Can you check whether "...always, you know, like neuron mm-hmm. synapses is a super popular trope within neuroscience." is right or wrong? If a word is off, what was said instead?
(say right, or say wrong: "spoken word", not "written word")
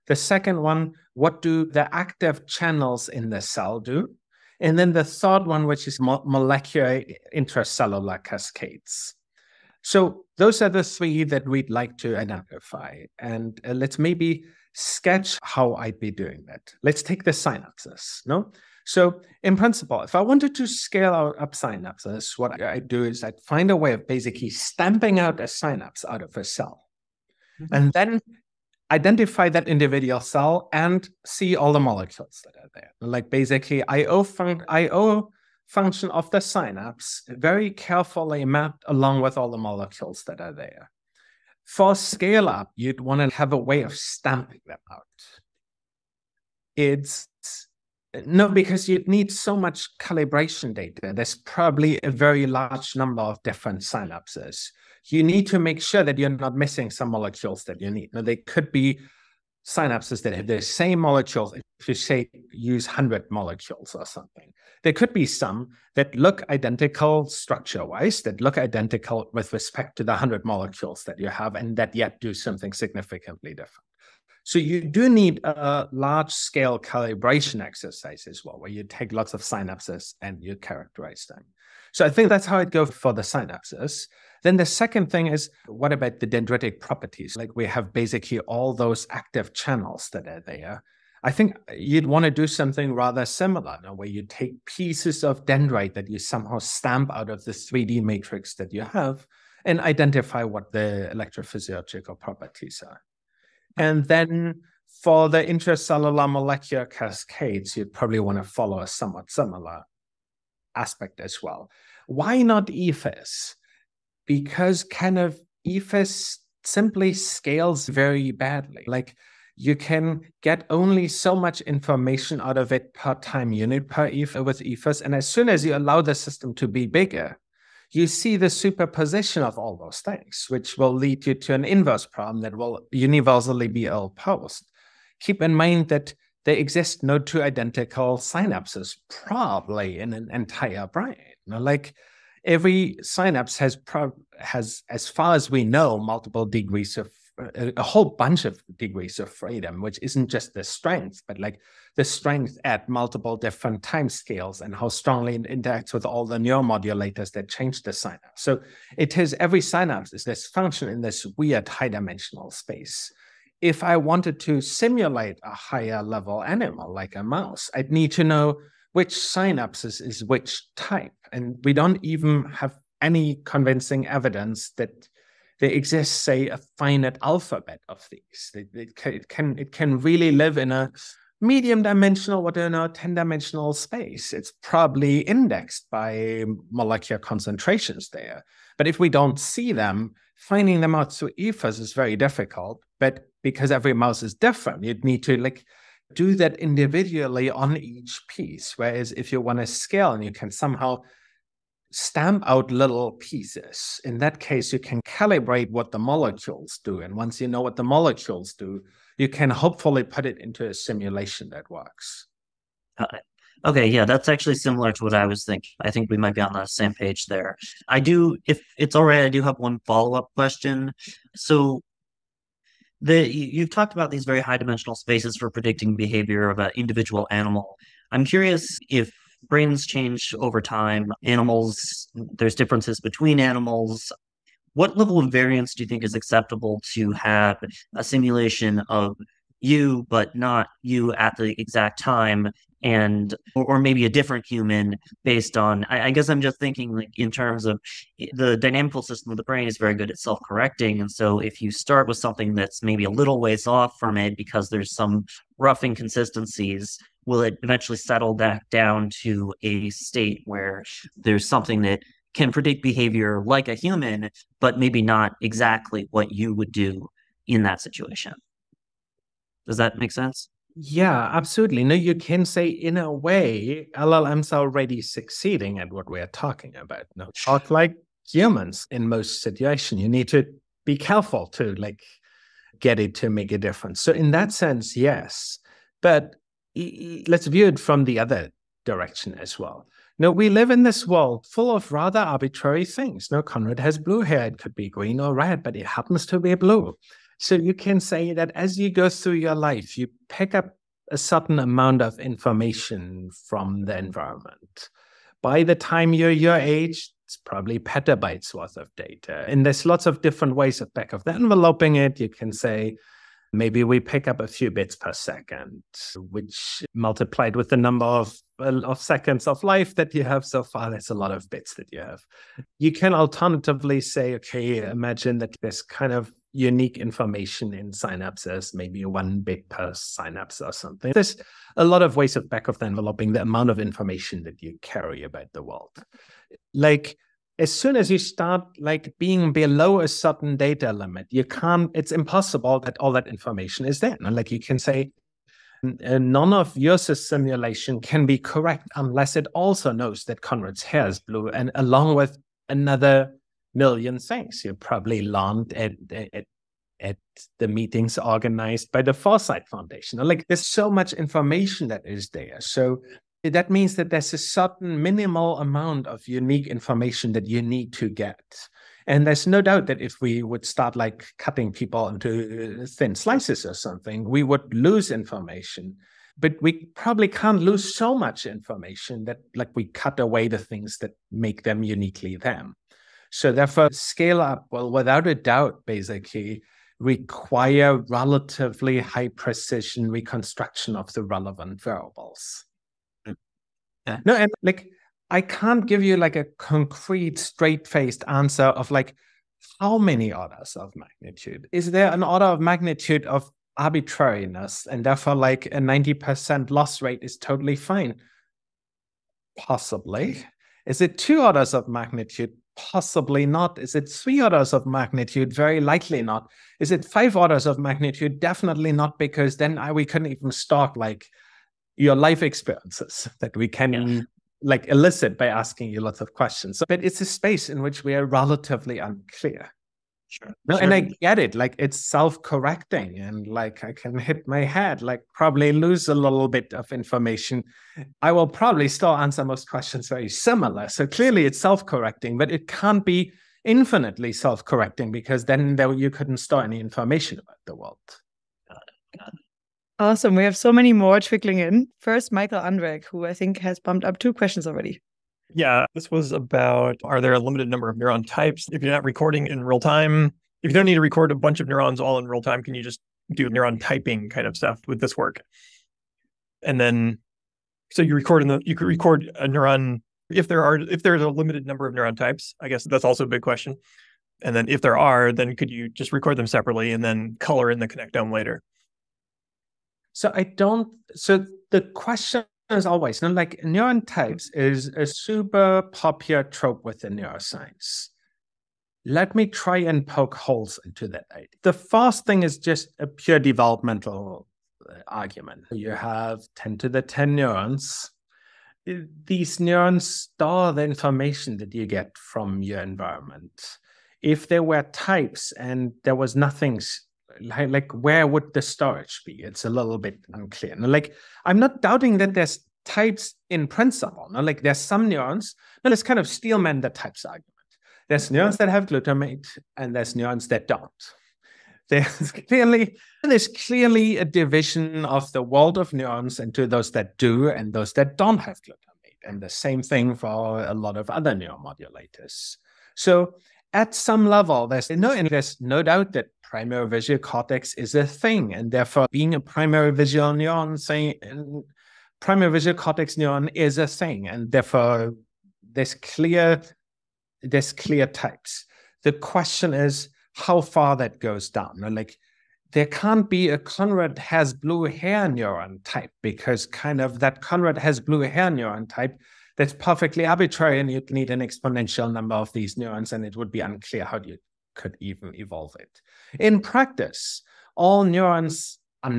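wrong: "types", not "synapses".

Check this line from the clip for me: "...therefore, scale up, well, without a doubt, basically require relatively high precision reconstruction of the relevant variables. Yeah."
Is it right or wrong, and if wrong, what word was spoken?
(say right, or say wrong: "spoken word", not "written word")
right.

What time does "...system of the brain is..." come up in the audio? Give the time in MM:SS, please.
04:09.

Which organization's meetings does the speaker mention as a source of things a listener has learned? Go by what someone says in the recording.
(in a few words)
Foresight Foundation.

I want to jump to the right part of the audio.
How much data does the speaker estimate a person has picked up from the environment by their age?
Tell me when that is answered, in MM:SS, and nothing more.
05:07.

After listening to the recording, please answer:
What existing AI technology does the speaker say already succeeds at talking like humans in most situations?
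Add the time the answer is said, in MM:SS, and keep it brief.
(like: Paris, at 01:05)
LLMs, at 04:33.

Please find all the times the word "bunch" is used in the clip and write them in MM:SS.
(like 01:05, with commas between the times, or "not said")
02:28, 07:41.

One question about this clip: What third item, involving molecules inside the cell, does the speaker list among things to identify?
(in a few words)
molecular intracellular cascades.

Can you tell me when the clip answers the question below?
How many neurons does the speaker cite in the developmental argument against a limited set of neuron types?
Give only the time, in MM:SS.
08:16.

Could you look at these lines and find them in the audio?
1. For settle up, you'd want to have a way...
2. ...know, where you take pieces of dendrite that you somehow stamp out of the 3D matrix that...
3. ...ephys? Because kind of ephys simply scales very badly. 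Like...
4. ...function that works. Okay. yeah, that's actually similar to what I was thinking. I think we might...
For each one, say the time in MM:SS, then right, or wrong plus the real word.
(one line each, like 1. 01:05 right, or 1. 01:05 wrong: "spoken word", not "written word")
1. 00:41 wrong: "scale", not "settle"
2. 01:33 right
3. 01:52 right
4. 03:30 wrong: "simulation", not "function".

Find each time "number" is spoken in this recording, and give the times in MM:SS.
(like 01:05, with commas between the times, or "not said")
00:52, 05:17, 07:37, 07:51, 09:22.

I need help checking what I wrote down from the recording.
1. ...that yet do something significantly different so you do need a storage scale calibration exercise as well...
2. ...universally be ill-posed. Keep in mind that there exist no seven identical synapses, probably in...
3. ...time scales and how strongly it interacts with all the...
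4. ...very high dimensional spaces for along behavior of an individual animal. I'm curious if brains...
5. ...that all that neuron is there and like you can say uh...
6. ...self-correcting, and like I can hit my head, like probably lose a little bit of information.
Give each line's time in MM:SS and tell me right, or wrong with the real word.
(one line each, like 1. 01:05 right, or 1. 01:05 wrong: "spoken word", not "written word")
1. 01:11 wrong: "large", not "storage"
2. 02:12 wrong: "two", not "seven"
3. 02:33 right
4. 03:44 wrong: "predicting", not "along"
5. 05:42 wrong: "information", not "neuron"
6. 07:12 right.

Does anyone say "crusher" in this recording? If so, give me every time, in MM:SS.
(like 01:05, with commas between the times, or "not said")
not said.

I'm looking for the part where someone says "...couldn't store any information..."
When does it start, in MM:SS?
07:26.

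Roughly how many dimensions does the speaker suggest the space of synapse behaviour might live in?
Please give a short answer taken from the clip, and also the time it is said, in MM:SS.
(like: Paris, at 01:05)
10, at 03:02.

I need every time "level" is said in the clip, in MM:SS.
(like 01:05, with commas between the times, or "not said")
02:46, 03:54, 08:54.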